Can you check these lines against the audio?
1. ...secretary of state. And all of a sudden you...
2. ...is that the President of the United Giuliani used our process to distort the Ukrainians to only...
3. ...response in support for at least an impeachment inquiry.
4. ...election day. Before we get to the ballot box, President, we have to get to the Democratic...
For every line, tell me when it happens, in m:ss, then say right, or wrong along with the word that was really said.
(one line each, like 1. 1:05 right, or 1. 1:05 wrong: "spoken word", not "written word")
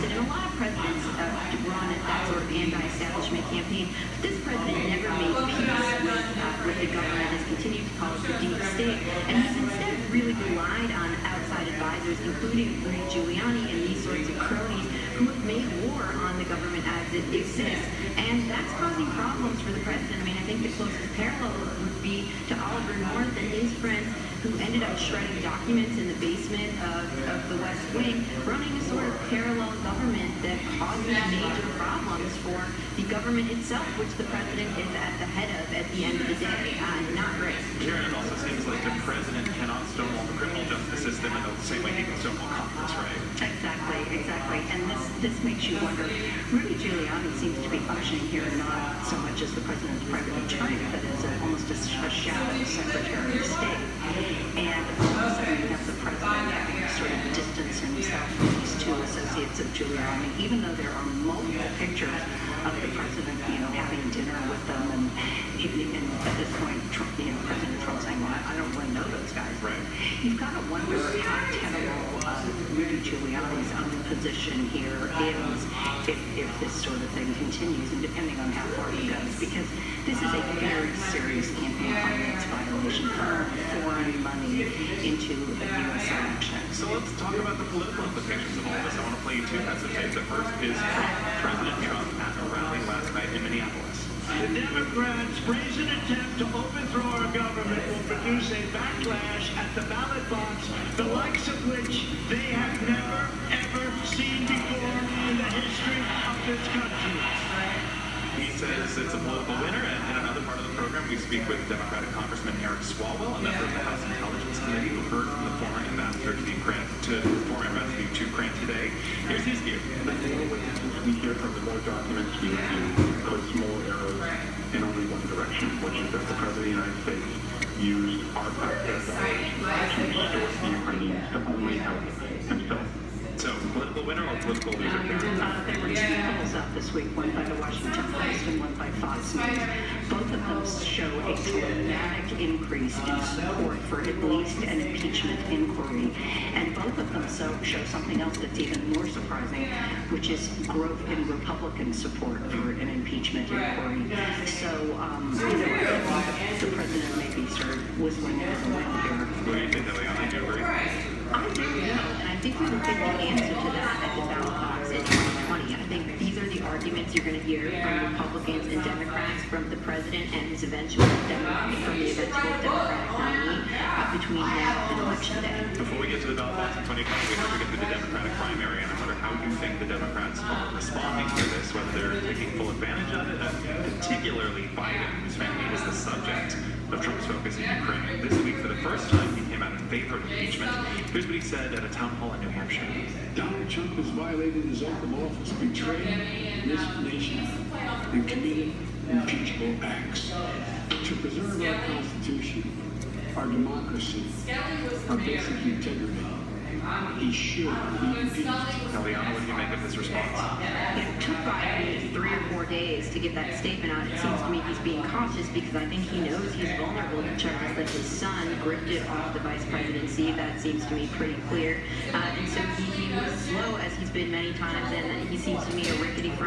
1. 0:52 right
2. 2:06 wrong: "States", not "Giuliani"
3. 2:22 wrong: "increase", not "response"
4. 2:55 wrong: "Antonio", not "President".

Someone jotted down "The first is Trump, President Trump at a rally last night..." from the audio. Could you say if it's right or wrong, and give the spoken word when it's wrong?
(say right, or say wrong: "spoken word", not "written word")
right.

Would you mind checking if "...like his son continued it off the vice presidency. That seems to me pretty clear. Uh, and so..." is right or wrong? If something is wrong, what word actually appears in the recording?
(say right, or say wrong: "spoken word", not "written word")
wrong: "gripped", not "continued".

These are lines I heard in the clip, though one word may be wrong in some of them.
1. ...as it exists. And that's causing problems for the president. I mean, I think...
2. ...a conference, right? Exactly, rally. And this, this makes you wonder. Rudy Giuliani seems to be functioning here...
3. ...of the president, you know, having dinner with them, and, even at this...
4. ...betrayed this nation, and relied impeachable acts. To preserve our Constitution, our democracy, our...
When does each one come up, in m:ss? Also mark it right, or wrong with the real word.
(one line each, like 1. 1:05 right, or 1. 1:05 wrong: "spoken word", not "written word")
1. 0:16 right
2. 0:42 wrong: "exactly", not "rally"
3. 1:02 right
4. 3:15 wrong: "committed", not "relied".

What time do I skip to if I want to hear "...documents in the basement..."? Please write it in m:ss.
0:25.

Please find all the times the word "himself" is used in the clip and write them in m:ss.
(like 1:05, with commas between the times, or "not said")
0:57, 2:12.